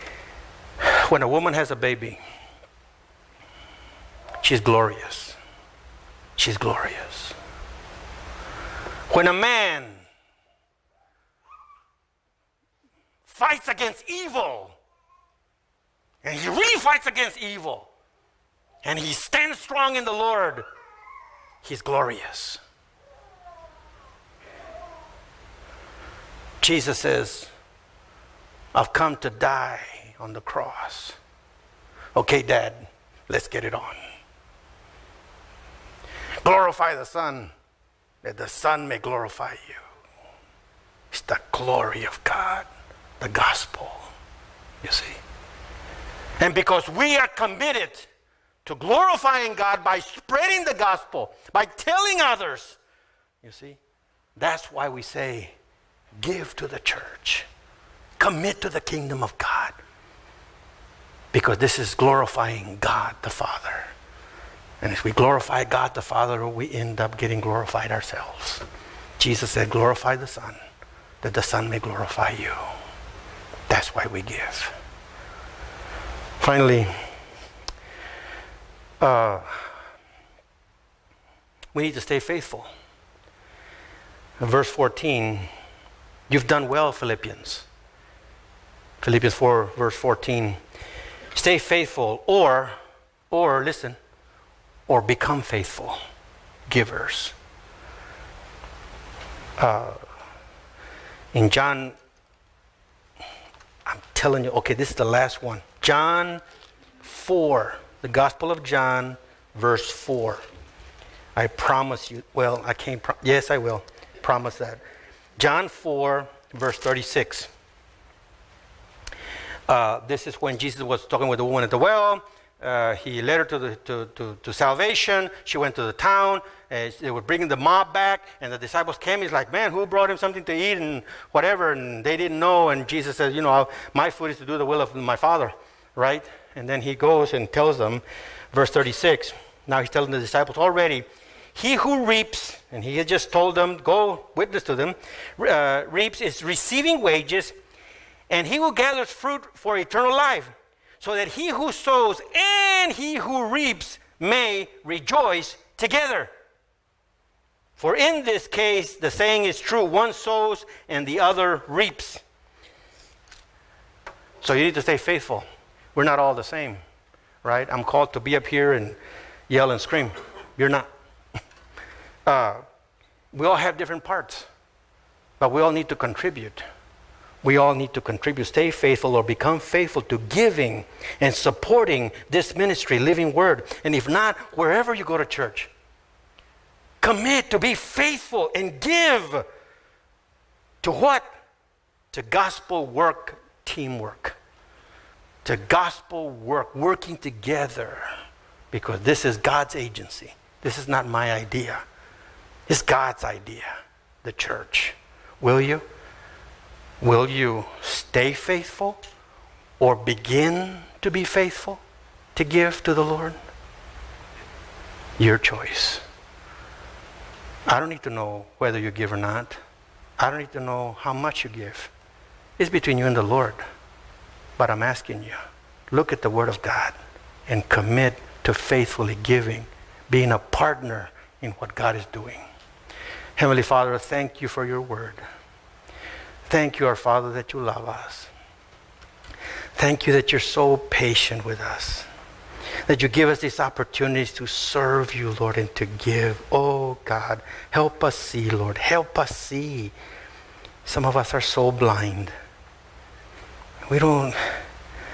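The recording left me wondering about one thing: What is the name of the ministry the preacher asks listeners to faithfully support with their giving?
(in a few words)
Living Word.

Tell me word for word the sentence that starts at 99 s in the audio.
Uh, in John, I'm telling you, okay, this is the last one.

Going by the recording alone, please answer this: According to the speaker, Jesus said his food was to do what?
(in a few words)
The will of my Father.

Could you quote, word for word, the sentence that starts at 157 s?
For in this case, the saying is true one sows and the other reaps.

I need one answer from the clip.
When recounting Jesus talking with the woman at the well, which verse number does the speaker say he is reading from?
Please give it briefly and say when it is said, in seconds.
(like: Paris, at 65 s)
36, at 115 s.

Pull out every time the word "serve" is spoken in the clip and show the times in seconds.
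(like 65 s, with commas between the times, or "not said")
244 s.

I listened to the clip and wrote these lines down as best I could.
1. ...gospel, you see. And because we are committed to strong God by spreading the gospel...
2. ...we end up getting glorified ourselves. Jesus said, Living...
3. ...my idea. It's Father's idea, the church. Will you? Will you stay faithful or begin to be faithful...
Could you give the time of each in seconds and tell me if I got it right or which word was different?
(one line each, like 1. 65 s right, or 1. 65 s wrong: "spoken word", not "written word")
1. 43 s wrong: "glorifying", not "strong"
2. 66 s wrong: "Glorify", not "Living"
3. 201 s wrong: "God", not "Father".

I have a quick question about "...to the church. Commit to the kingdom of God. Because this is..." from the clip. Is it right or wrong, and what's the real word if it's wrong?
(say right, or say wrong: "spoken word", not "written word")
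right.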